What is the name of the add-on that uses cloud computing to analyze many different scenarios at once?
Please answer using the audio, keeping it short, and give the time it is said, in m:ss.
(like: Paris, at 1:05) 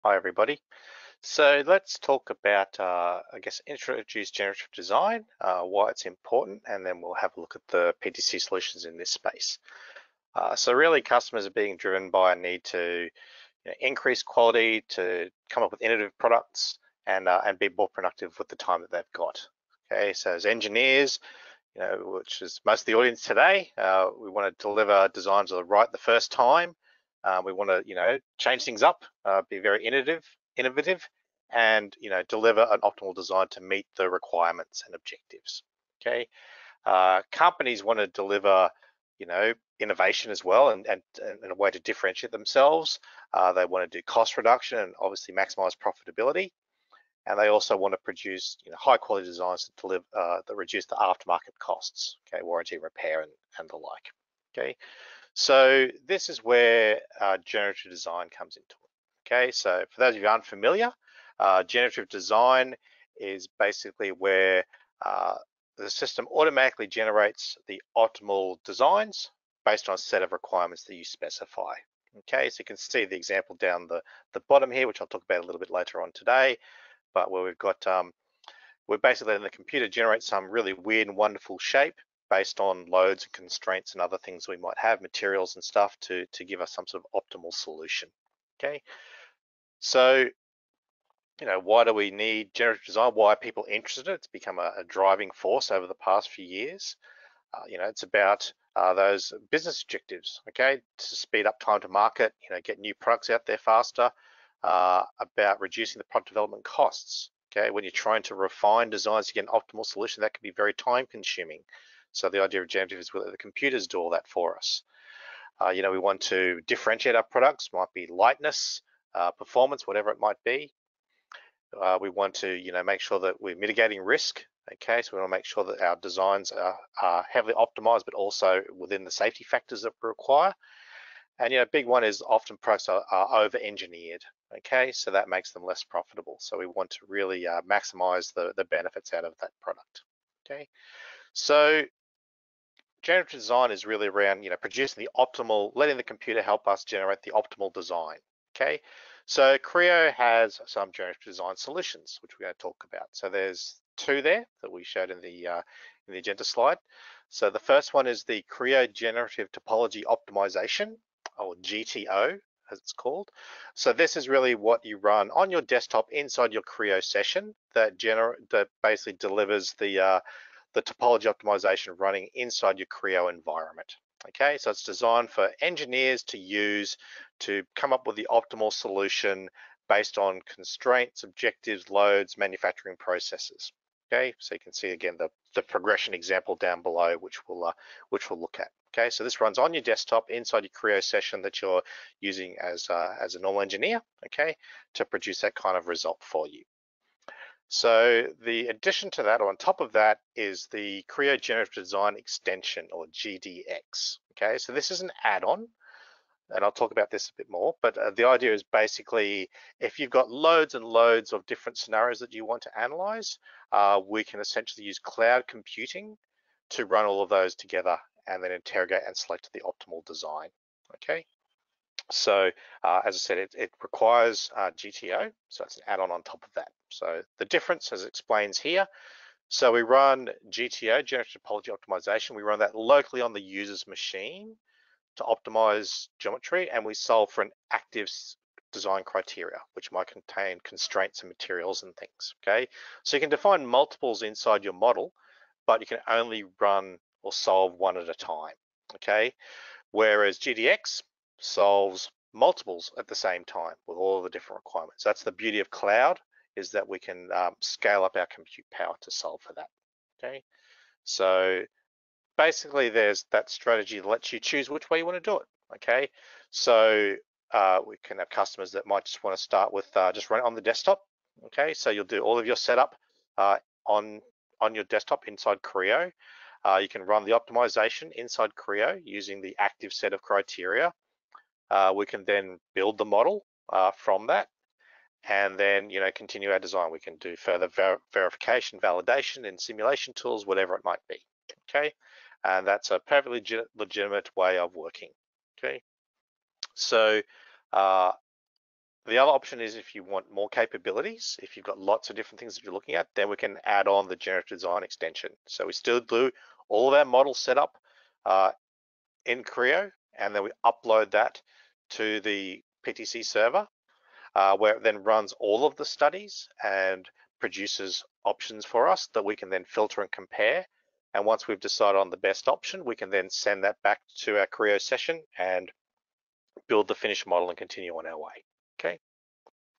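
Creo Generative Design Extension, at 3:21.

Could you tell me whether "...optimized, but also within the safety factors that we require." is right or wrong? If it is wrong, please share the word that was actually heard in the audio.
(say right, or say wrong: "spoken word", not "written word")
right.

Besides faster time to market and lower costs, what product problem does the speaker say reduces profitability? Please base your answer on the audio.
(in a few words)
over-engineered.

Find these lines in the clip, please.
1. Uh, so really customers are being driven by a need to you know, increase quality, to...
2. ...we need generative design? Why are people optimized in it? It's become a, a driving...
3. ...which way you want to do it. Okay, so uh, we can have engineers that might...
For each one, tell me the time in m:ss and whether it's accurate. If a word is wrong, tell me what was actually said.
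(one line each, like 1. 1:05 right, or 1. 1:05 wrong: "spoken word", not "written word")
1. 0:10 right
2. 1:31 wrong: "interested", not "optimized"
3. 4:24 wrong: "customers", not "engineers".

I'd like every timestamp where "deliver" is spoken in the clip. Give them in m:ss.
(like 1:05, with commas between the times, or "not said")
0:24, 0:32, 0:38, 0:49, 2:49.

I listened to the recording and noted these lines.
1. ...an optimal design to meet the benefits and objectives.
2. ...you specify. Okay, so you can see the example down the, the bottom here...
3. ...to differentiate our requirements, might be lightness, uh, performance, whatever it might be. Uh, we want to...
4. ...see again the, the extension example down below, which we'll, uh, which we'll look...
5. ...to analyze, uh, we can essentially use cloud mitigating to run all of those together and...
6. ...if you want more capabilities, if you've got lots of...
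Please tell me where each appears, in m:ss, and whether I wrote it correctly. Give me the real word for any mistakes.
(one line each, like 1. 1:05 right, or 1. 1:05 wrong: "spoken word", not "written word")
1. 0:32 wrong: "requirements", not "benefits"
2. 1:10 right
3. 1:56 wrong: "products", not "requirements"
4. 3:04 wrong: "progression", not "extension"
5. 3:32 wrong: "computing", not "mitigating"
6. 4:59 right.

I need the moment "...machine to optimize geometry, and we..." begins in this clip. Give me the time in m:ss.
3:53.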